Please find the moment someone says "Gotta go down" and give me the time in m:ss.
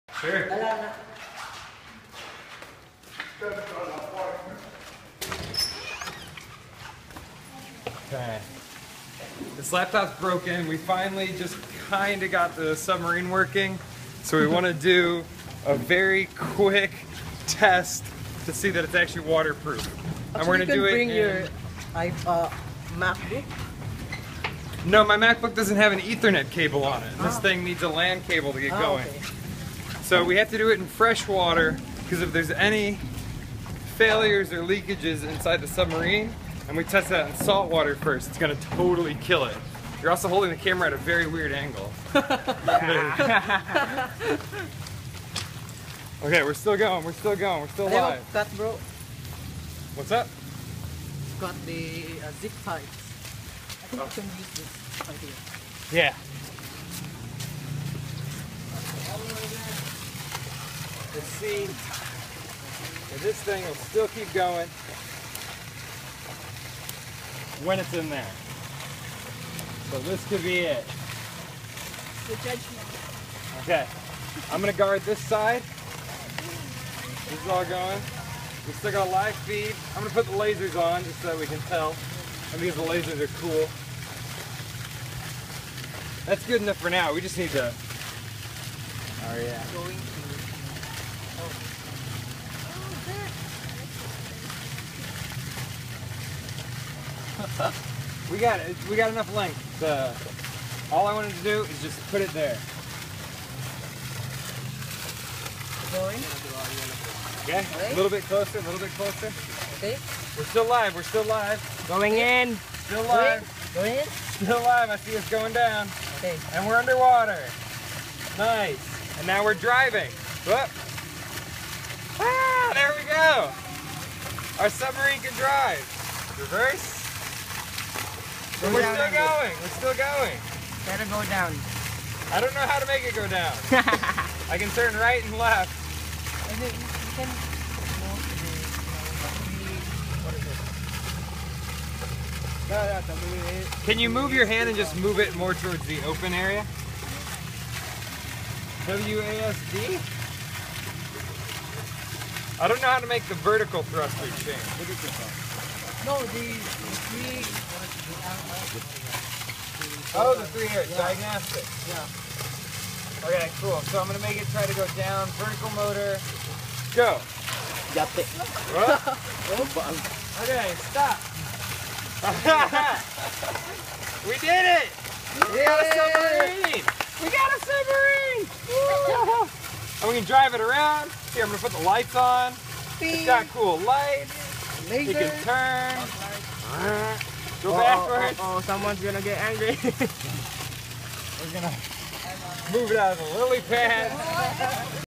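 2:10.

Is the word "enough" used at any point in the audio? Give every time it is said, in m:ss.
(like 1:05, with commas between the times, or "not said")
1:26, 1:39.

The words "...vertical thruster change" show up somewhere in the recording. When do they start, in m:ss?
2:33.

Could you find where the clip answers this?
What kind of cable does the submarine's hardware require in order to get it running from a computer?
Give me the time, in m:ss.
0:27.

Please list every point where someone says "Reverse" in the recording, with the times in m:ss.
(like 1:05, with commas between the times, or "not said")
2:06.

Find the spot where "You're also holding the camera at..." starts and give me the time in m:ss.
0:40.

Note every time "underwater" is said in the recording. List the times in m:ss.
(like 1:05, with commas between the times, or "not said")
1:56.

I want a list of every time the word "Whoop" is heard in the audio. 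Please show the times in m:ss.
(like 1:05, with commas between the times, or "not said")
2:00.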